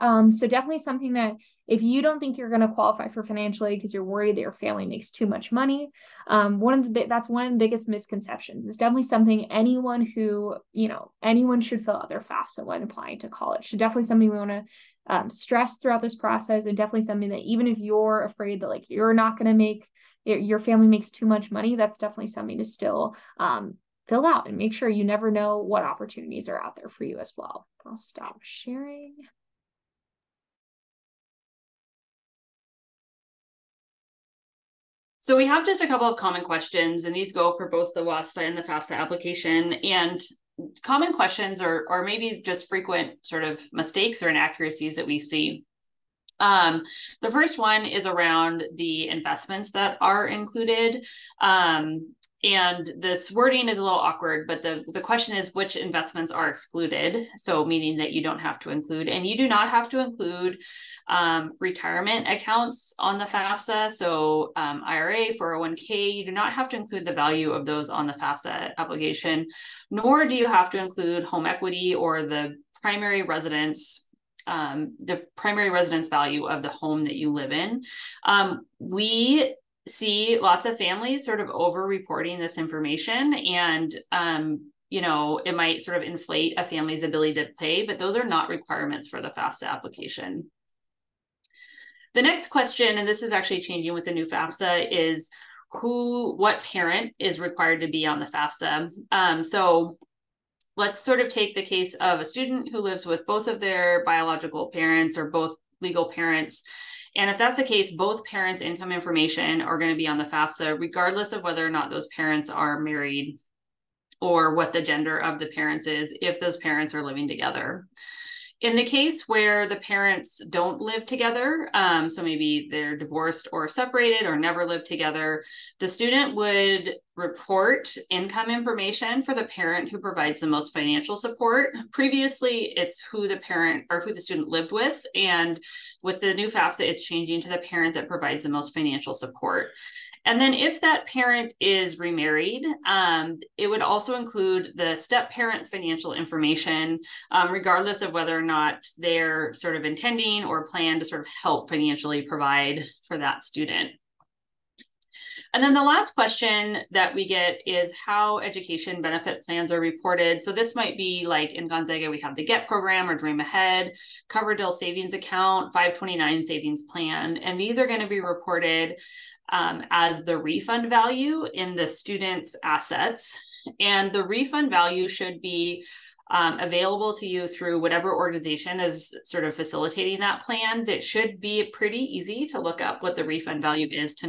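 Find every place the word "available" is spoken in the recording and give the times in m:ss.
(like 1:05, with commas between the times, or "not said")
2:56.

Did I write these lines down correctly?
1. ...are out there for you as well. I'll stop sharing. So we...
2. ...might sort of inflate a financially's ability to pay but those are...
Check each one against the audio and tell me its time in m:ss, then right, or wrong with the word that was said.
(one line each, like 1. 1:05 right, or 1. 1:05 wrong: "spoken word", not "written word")
1. 0:26 right
2. 1:25 wrong: "family", not "financially".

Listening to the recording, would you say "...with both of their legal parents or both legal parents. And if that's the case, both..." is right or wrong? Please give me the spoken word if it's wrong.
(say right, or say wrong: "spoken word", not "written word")
wrong: "biological", not "legal".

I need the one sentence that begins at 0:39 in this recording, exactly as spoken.
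And common questions or or maybe just frequent sort of mistakes or inaccuracies that we see.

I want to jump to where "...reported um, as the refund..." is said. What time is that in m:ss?
2:48.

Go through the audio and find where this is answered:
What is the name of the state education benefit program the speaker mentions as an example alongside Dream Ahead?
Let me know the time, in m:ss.
2:42.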